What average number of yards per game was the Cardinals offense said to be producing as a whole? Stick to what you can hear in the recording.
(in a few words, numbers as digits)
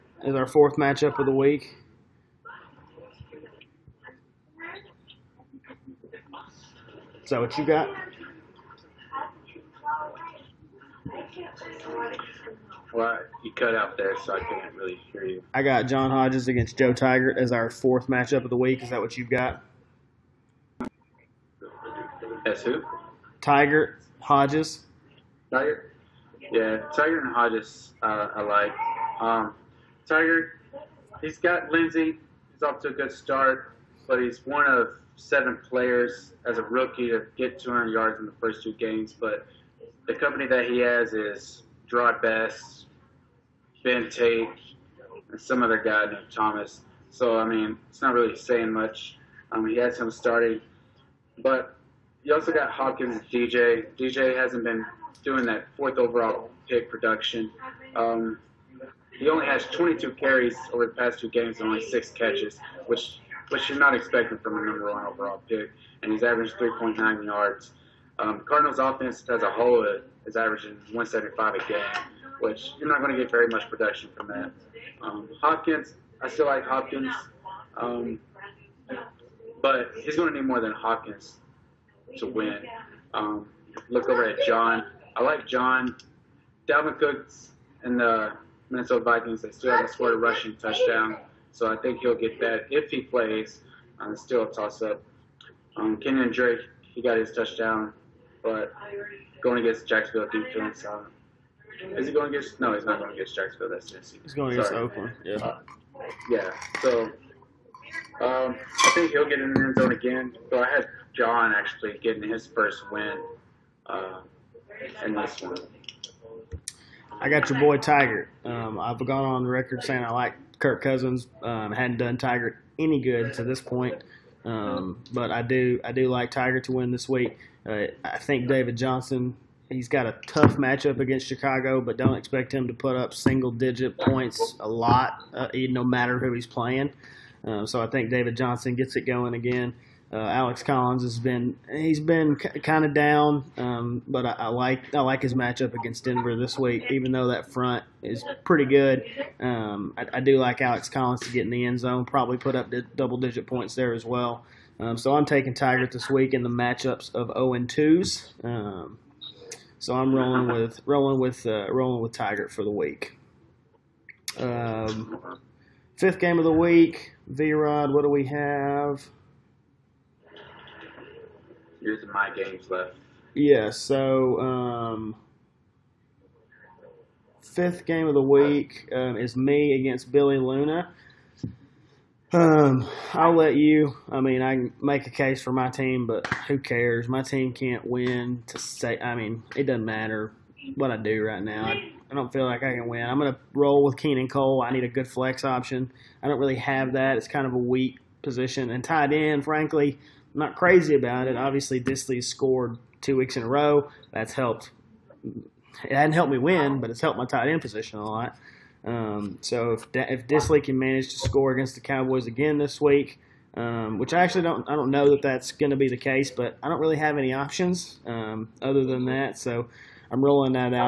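175.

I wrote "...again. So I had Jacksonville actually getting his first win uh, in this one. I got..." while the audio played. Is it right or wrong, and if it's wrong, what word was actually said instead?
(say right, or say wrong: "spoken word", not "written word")
wrong: "John", not "Jacksonville".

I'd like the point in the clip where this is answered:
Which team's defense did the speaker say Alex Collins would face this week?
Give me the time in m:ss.
2:26.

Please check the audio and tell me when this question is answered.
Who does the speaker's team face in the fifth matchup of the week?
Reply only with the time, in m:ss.
3:00.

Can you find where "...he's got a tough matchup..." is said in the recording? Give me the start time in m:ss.
2:09.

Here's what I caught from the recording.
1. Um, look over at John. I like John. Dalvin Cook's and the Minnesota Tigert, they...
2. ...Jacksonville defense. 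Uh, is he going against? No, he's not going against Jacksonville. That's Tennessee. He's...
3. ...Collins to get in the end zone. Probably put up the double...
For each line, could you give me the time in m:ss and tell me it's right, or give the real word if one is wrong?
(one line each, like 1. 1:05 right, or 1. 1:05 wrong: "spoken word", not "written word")
1. 1:23 wrong: "Vikings", not "Tigert"
2. 1:39 right
3. 2:30 right.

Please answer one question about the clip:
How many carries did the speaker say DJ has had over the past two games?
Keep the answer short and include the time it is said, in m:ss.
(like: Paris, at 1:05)
22, at 0:59.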